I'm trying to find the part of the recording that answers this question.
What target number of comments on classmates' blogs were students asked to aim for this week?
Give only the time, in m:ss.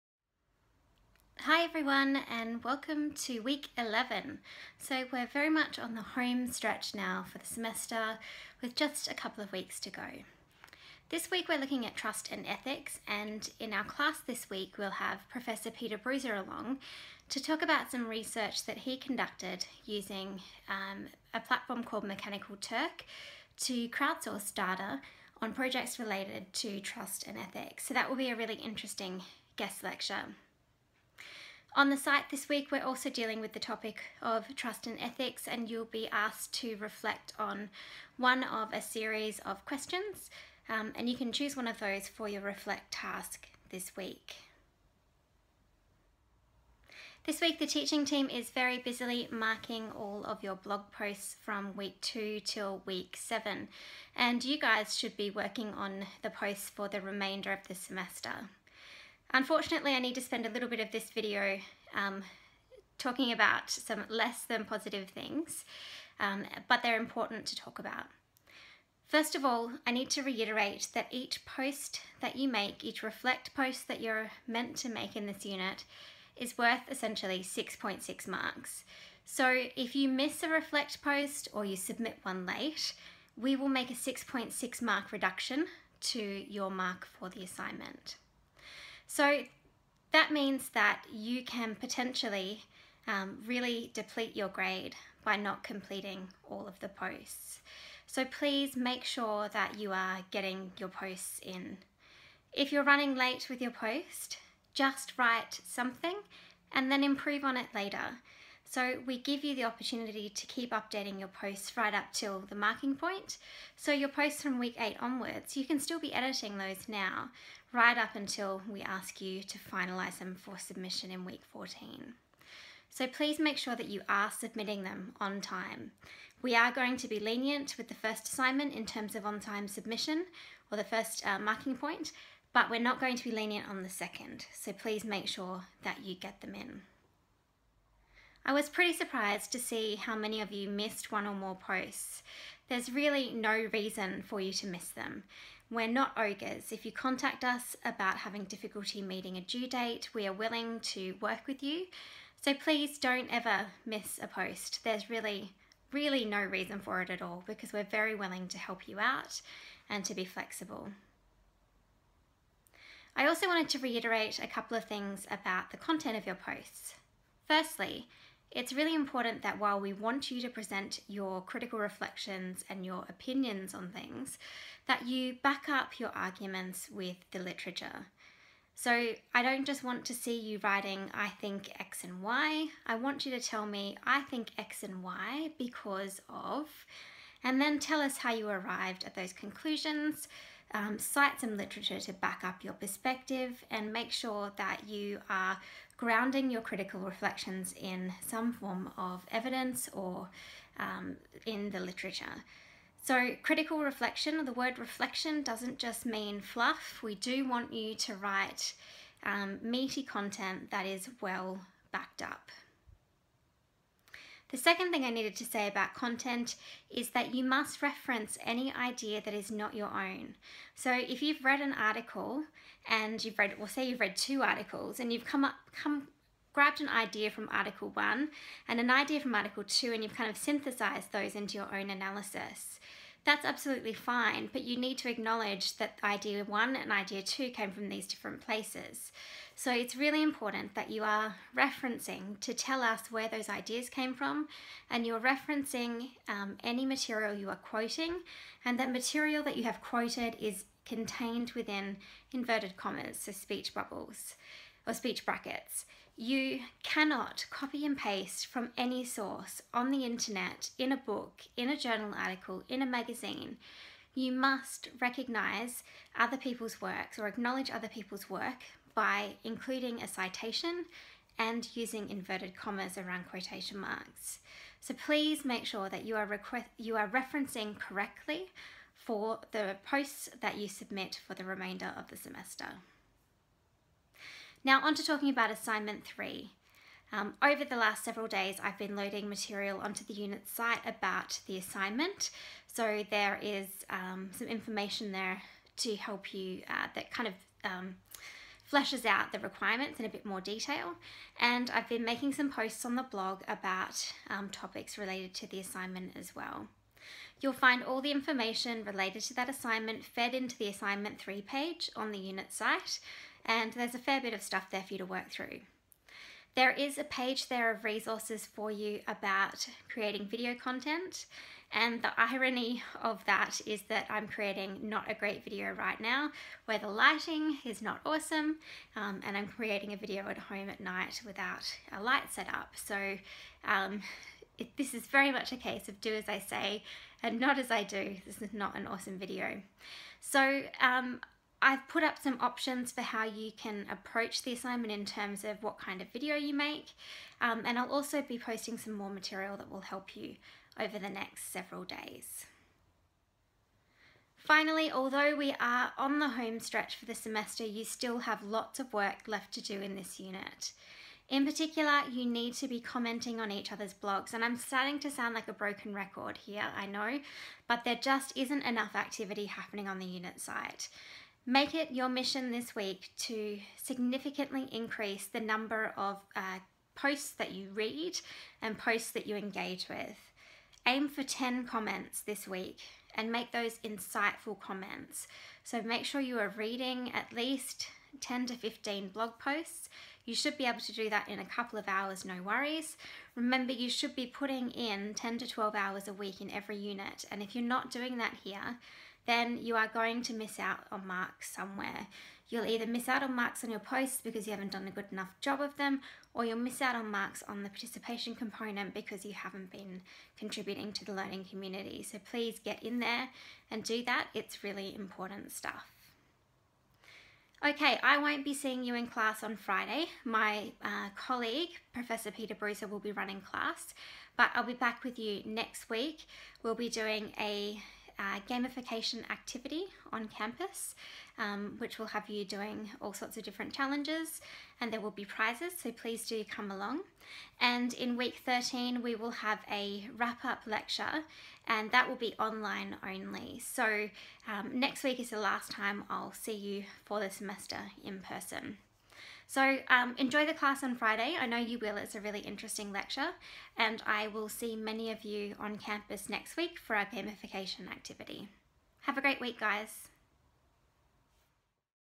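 6:21.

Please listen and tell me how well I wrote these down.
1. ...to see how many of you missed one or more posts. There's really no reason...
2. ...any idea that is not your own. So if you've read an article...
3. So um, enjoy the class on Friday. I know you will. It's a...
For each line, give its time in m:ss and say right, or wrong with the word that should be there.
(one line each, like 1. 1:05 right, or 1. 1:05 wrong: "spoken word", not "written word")
1. 2:19 right
2. 3:38 right
3. 7:29 right.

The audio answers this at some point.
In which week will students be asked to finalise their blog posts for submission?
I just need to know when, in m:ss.
2:01.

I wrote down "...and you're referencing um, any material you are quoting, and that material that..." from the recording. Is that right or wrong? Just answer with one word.
right.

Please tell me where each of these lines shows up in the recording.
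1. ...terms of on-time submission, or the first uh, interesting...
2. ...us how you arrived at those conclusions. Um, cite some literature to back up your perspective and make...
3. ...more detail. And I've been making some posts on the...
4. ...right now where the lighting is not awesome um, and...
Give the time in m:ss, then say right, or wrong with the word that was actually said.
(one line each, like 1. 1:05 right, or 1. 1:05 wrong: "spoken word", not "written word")
1. 2:08 wrong: "marking", not "interesting"
2. 3:08 right
3. 5:00 right
4. 5:25 right.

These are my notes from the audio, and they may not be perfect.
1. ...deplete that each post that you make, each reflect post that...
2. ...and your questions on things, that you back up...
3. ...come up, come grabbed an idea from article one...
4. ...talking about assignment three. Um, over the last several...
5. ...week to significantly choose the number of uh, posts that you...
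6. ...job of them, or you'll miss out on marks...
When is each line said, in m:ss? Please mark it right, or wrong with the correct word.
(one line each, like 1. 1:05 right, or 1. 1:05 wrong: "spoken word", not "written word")
1. 1:10 wrong: "reiterate", not "deplete"
2. 2:52 wrong: "opinions", not "questions"
3. 3:45 right
4. 4:45 right
5. 6:12 wrong: "increase", not "choose"
6. 6:45 right.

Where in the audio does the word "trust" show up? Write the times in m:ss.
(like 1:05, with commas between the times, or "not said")
0:11, 0:26, 0:34.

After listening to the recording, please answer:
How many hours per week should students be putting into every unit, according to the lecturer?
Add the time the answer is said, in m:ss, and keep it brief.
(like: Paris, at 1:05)
10 to 12, at 6:35.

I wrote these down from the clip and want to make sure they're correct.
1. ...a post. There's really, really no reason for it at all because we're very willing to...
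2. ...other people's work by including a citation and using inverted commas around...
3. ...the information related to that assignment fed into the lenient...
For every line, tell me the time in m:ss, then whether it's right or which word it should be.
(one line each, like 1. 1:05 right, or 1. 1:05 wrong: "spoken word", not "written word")
1. 2:34 right
2. 4:27 right
3. 5:08 wrong: "assignment", not "lenient".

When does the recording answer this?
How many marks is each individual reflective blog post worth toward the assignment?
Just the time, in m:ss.
1:17.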